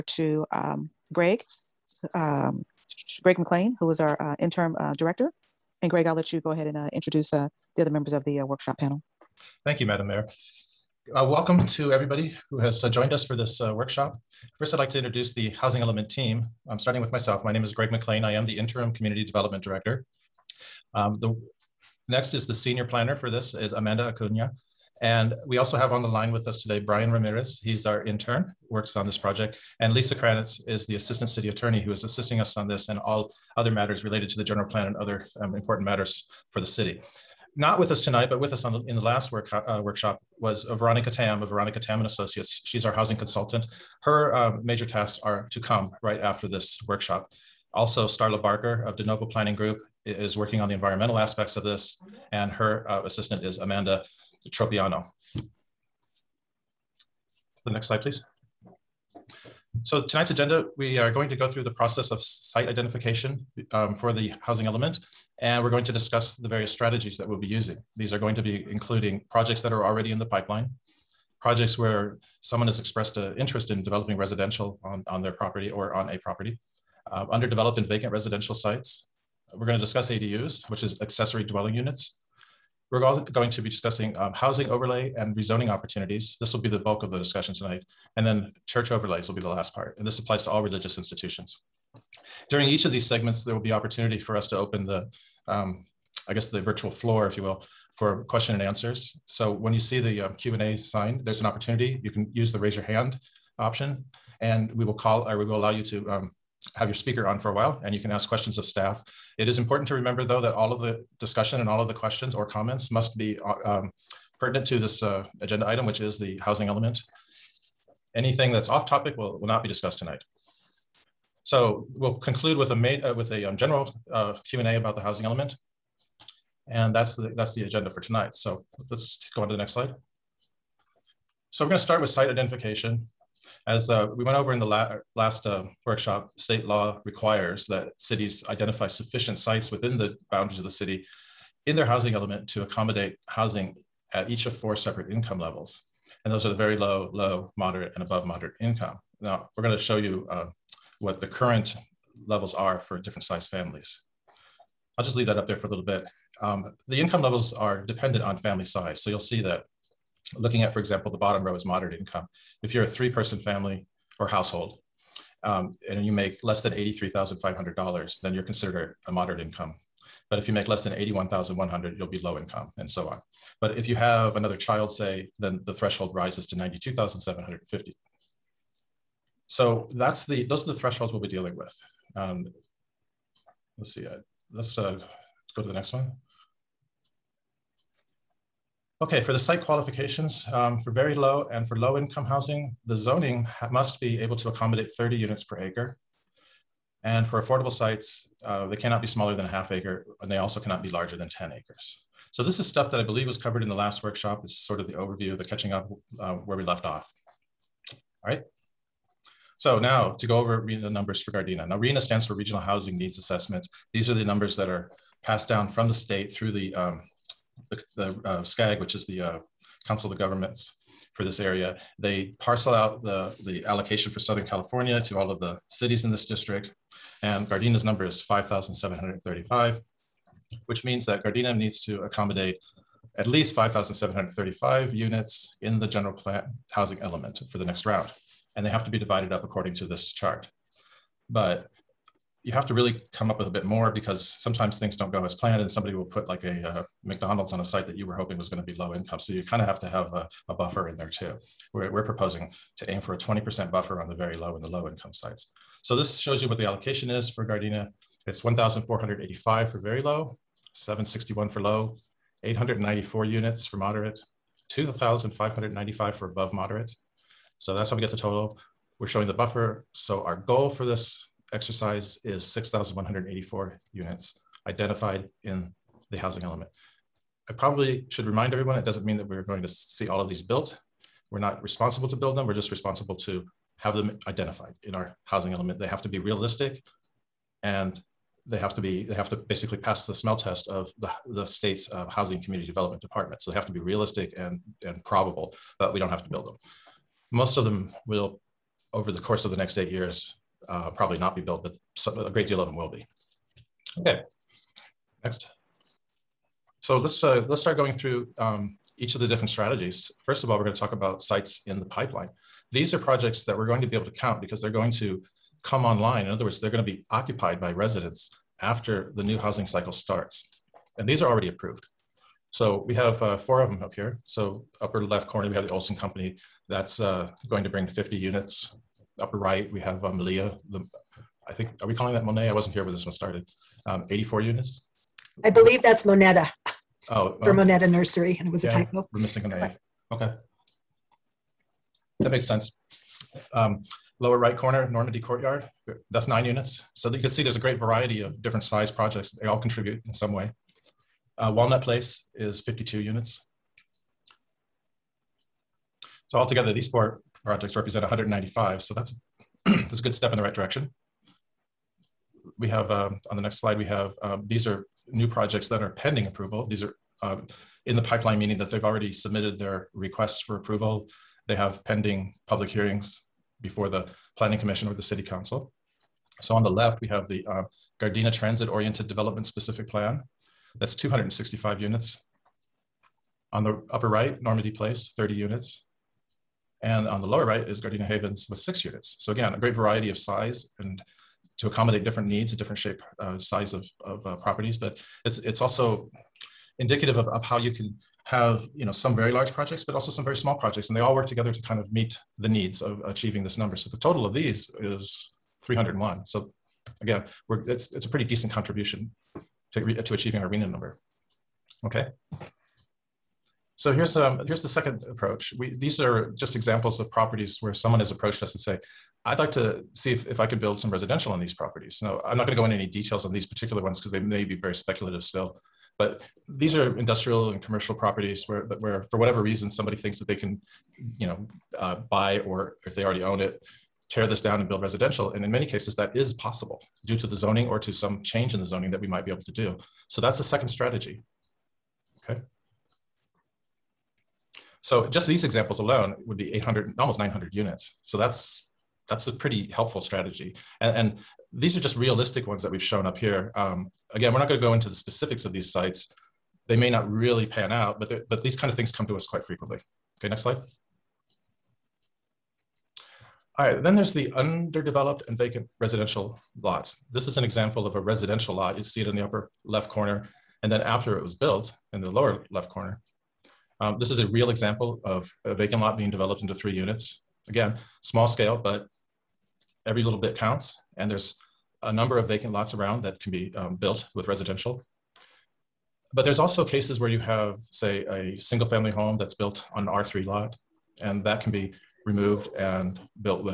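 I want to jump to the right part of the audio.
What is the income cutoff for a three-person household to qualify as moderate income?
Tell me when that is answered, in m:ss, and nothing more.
2:46.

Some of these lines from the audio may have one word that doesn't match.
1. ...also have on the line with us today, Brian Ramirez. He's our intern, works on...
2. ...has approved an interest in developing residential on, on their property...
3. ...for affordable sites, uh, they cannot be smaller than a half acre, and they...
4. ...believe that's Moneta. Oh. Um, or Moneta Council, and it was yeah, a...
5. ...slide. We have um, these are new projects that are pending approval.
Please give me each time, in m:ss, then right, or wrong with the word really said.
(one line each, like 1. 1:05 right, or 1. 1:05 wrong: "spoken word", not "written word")
1. 0:25 right
2. 1:12 wrong: "expressed", not "approved"
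3. 3:17 right
4. 5:35 wrong: "Nursery", not "Council"
5. 6:03 right.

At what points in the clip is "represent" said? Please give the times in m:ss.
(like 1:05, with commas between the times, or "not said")
5:57.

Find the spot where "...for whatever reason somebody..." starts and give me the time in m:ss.
7:09.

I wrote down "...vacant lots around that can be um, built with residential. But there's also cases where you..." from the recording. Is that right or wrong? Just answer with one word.
right.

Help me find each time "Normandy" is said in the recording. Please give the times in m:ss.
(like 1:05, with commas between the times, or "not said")
5:44, 6:24.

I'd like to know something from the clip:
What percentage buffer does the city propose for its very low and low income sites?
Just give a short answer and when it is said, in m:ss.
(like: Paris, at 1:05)
20%, at 4:13.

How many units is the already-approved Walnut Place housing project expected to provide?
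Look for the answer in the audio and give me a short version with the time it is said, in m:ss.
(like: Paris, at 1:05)
52, at 5:52.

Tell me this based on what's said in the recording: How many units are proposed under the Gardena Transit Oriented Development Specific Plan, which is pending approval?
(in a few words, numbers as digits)
265.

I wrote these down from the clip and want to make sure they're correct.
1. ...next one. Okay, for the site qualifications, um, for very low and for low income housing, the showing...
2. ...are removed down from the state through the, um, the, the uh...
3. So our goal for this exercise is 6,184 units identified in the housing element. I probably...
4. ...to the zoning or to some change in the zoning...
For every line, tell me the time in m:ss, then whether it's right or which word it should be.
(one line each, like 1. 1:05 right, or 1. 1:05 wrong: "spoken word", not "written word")
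1. 3:05 wrong: "zoning", not "showing"
2. 3:34 wrong: "passed", not "removed"
3. 4:29 right
4. 7:17 right.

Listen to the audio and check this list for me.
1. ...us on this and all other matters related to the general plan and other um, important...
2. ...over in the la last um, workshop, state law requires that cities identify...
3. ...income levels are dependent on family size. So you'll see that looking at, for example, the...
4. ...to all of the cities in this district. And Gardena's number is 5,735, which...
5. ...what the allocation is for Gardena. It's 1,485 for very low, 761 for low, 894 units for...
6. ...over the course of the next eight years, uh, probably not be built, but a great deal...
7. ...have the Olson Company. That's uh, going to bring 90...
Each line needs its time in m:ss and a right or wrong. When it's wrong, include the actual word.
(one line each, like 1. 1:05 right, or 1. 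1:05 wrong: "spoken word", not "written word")
1. 0:32 right
2. 2:14 right
3. 2:36 right
4. 3:45 right
5. 4:16 right
6. 4:58 right
7. 5:25 wrong: "50", not "90".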